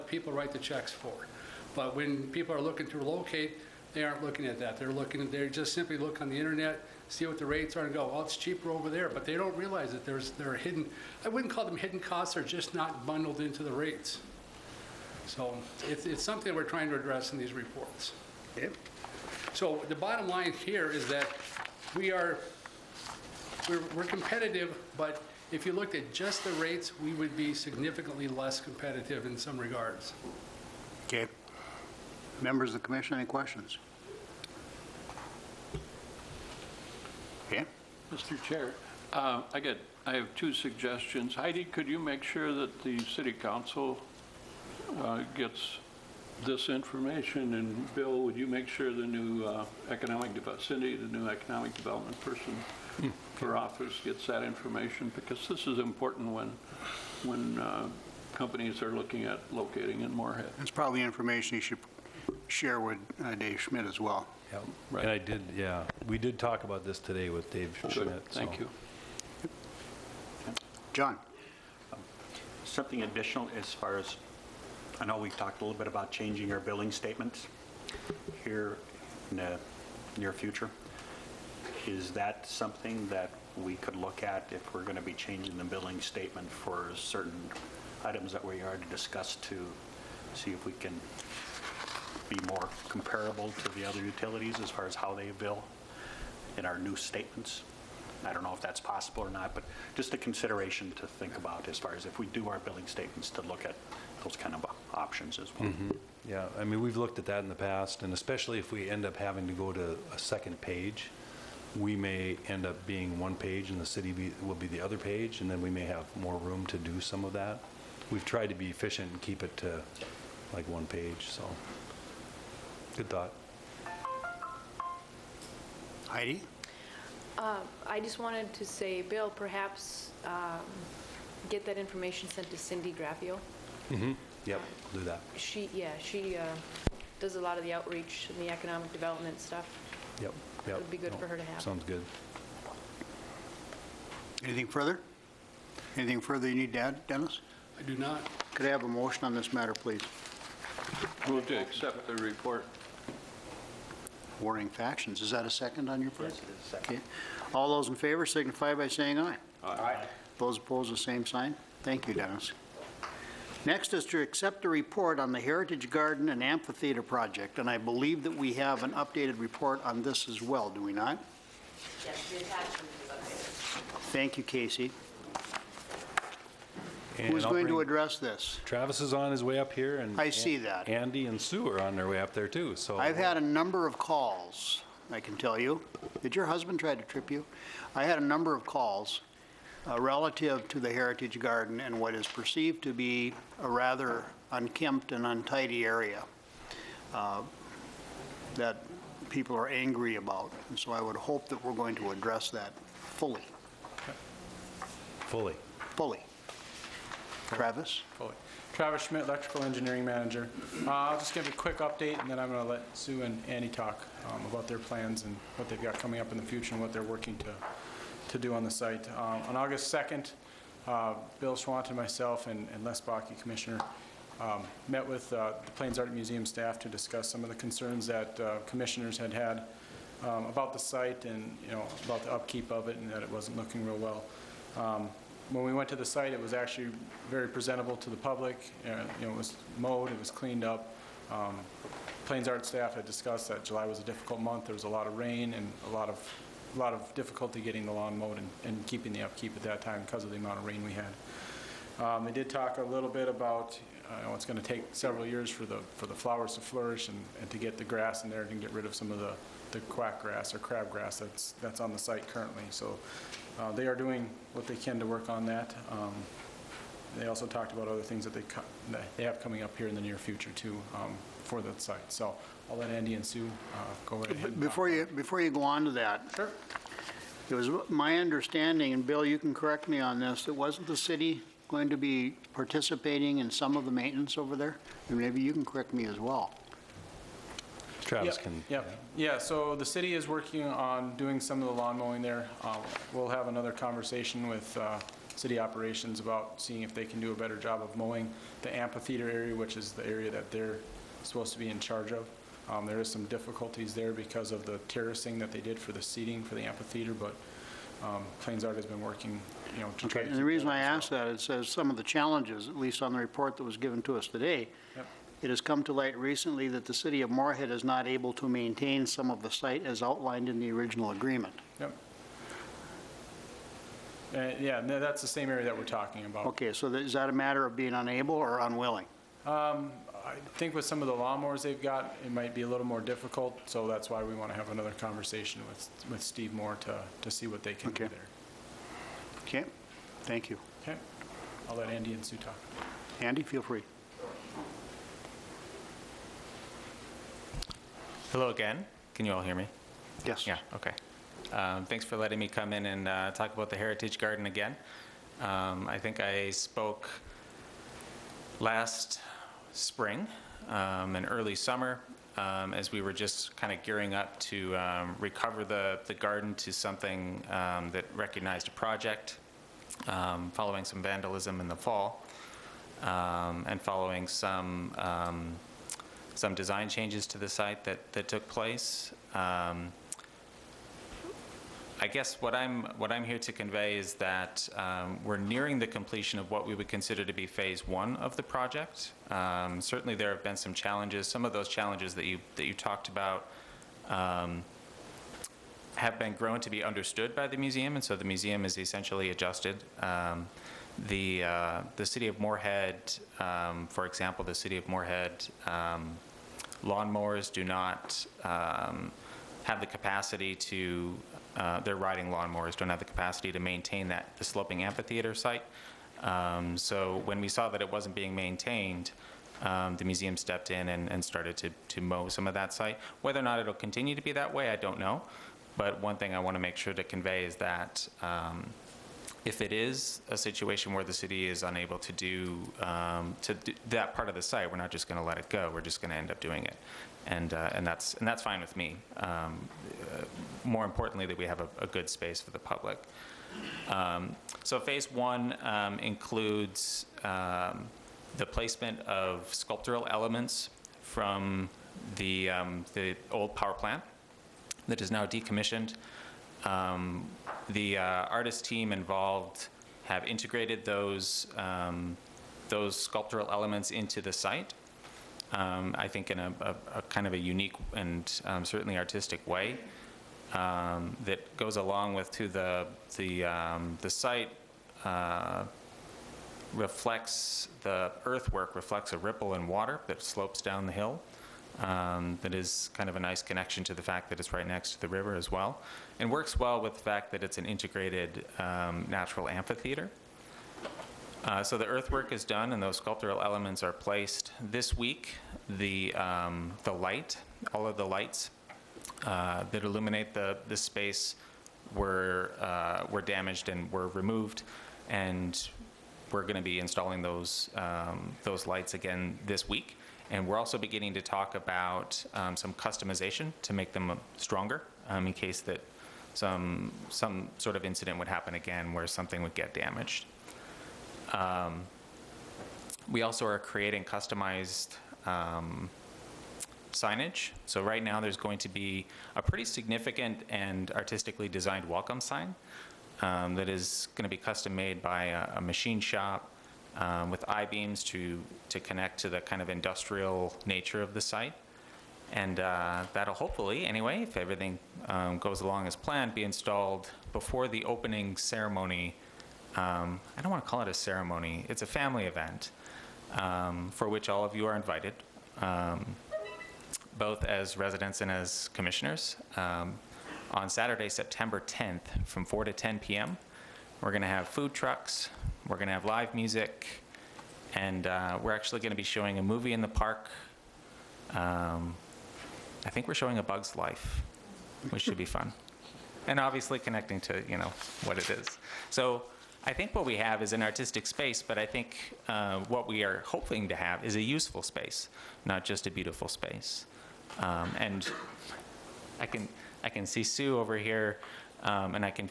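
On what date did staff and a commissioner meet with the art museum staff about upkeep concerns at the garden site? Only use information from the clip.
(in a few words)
August 2nd.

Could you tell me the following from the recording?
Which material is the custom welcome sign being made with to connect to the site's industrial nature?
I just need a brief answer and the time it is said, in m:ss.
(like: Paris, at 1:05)
I-beams, at 8:57.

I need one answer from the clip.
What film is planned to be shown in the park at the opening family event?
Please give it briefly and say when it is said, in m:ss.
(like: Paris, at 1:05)
A Bug's Life, at 9:33.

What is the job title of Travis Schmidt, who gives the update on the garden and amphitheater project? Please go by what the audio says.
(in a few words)
Electrical Engineering Manager.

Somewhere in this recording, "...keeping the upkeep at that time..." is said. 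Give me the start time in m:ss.
4:08.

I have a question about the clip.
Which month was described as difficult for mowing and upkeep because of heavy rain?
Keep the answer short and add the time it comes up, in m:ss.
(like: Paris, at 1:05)
July, at 4:03.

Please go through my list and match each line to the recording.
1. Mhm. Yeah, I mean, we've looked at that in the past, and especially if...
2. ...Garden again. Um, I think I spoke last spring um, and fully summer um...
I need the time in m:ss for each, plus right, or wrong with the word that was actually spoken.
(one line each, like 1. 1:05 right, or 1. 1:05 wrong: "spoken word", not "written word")
1. 1:45 right
2. 5:54 wrong: "early", not "fully".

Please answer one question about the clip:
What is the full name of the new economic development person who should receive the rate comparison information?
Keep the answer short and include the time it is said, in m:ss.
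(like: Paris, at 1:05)
Cindy Graffeo, at 2:12.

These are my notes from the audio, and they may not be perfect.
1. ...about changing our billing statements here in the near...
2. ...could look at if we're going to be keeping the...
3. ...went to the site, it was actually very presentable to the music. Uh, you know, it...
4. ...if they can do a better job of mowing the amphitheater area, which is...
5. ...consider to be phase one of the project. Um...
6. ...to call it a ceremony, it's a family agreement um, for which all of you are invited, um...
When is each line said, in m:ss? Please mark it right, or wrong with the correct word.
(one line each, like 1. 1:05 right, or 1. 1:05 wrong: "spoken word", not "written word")
1. 1:15 right
2. 1:23 wrong: "changing", not "keeping"
3. 3:55 wrong: "public", not "music"
4. 4:56 right
5. 6:26 right
6. 9:10 wrong: "event", not "agreement".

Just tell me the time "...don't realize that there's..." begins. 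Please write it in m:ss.
0:09.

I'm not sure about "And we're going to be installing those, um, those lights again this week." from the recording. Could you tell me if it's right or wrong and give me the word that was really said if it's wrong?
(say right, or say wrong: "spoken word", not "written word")
right.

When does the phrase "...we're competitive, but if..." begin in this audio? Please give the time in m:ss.
0:23.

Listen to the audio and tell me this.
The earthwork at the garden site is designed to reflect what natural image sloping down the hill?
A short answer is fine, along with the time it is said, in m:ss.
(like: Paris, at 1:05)
A ripple in water, at 7:59.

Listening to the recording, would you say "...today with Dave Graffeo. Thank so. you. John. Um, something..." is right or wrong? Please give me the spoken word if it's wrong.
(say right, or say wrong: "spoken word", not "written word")
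wrong: "Schmidt", not "Graffeo".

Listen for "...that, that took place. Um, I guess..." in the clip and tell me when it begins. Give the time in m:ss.
6:17.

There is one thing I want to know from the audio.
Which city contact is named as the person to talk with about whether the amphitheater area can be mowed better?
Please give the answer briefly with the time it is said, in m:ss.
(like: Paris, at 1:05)
Steve Moore, at 5:36.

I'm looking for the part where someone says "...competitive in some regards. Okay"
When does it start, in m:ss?
0:28.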